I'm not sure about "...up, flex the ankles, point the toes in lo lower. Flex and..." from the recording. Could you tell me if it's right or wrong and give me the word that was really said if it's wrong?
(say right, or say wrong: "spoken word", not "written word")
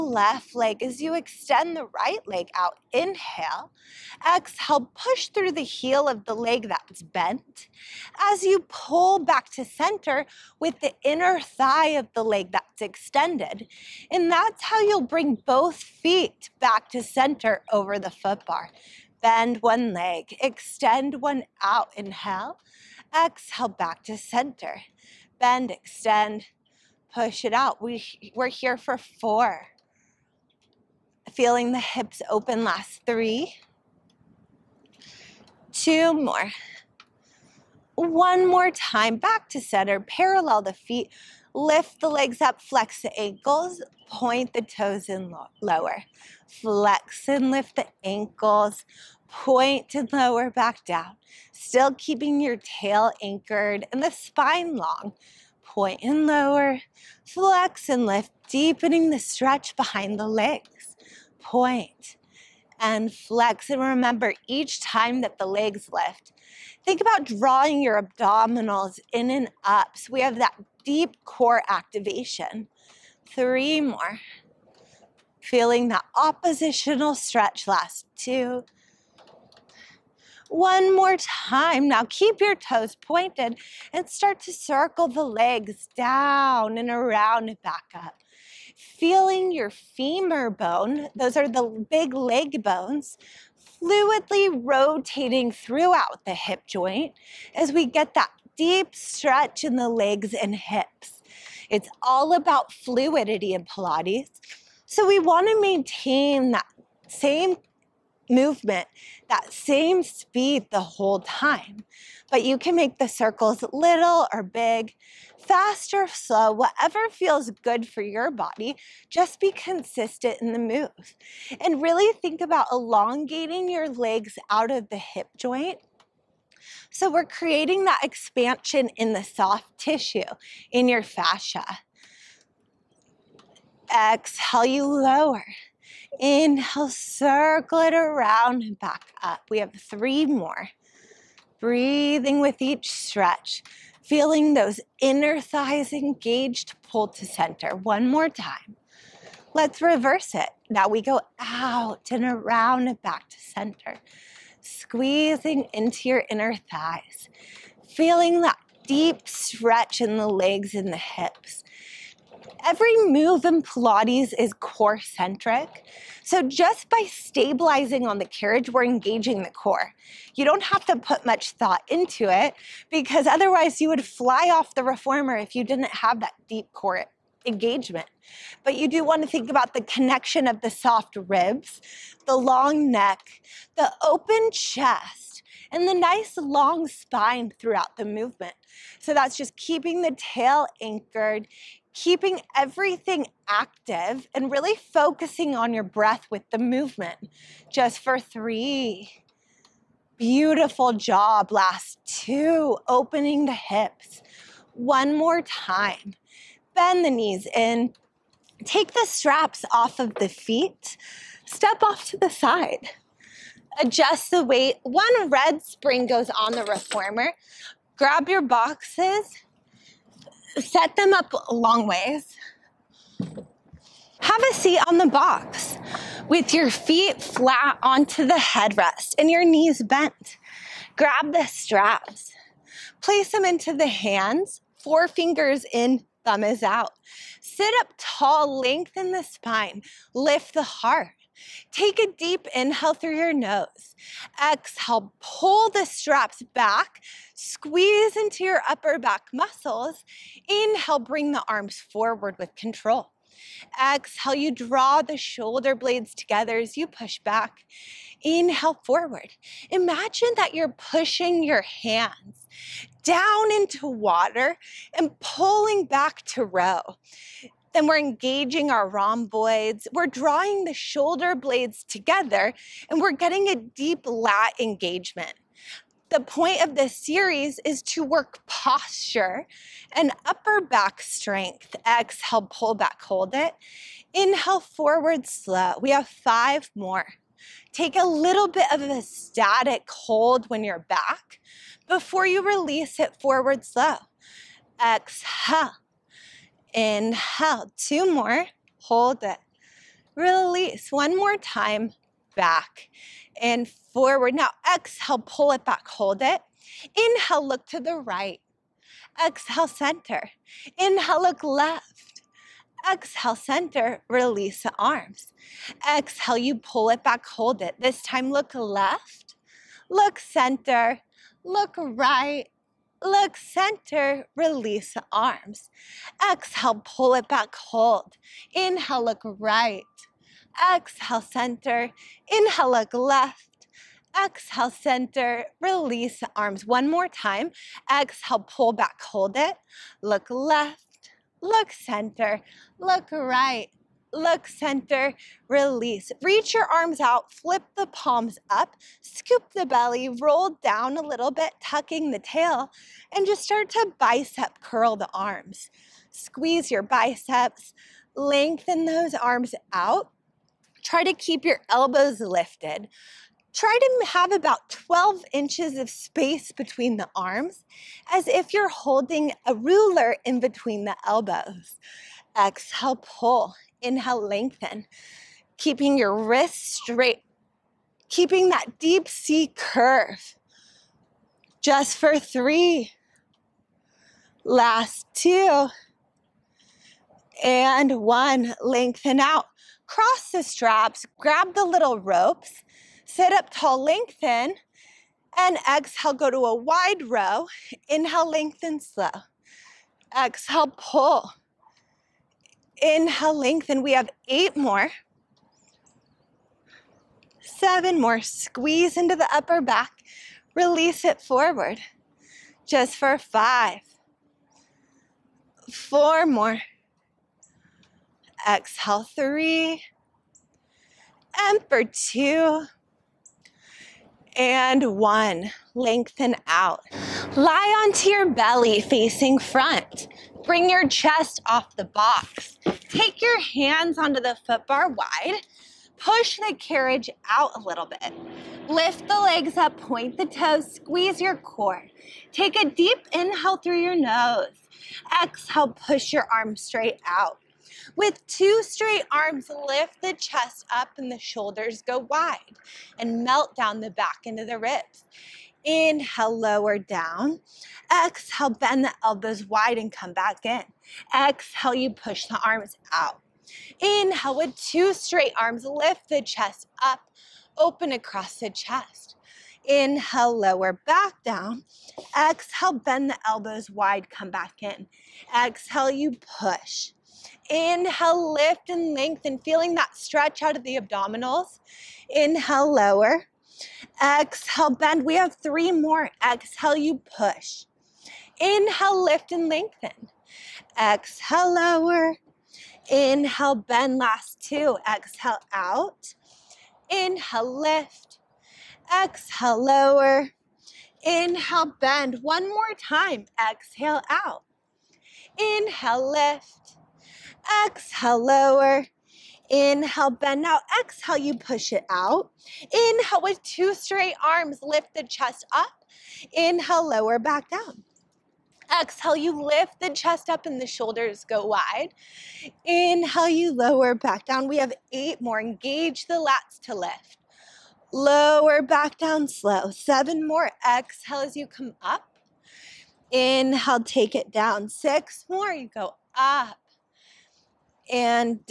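right.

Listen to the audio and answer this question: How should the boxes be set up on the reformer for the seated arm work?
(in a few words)
Long ways.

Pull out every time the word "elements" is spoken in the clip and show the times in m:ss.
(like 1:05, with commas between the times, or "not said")
not said.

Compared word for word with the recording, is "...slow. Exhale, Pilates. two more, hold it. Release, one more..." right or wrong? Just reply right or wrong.
wrong.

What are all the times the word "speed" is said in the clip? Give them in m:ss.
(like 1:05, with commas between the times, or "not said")
1:50.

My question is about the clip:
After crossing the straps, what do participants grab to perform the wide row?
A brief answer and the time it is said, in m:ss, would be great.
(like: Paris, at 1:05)
Little ropes, at 6:31.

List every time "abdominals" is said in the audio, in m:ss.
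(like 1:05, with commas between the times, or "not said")
1:08, 8:00.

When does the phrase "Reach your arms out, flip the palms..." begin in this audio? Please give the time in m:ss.
5:46.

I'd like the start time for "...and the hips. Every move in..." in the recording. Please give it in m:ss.
2:40.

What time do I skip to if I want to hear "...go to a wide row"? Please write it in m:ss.
6:36.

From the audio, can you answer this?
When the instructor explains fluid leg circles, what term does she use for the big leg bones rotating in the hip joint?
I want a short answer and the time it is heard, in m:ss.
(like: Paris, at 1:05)
femur bone, at 1:29.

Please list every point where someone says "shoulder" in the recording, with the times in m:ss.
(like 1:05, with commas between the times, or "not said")
4:15, 4:30, 7:31, 8:40.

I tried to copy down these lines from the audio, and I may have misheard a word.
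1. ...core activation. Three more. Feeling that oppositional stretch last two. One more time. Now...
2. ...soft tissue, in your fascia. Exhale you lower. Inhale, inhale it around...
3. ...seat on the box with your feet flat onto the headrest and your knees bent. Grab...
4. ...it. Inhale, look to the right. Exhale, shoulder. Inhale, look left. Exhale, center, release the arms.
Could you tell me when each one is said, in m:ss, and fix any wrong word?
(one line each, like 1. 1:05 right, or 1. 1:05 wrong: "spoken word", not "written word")
1. 1:11 right
2. 2:09 wrong: "circle", not "inhale"
3. 3:44 right
4. 5:06 wrong: "center", not "shoulder".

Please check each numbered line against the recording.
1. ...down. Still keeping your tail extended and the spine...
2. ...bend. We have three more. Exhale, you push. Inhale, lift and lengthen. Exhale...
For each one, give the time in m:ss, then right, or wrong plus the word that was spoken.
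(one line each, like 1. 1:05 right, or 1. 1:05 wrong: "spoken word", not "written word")
1. 0:50 wrong: "anchored", not "extended"
2. 8:04 right.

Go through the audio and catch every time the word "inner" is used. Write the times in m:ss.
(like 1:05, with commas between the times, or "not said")
0:11, 2:24, 2:36.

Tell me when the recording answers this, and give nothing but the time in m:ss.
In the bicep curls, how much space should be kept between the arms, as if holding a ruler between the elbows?
6:04.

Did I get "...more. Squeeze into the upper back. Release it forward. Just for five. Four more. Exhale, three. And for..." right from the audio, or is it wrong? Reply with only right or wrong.
right.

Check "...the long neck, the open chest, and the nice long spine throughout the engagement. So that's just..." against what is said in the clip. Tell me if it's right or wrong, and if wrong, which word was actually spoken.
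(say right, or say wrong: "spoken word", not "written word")
wrong: "movement", not "engagement".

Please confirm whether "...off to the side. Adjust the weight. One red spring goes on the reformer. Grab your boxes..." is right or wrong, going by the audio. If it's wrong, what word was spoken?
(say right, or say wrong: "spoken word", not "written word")
right.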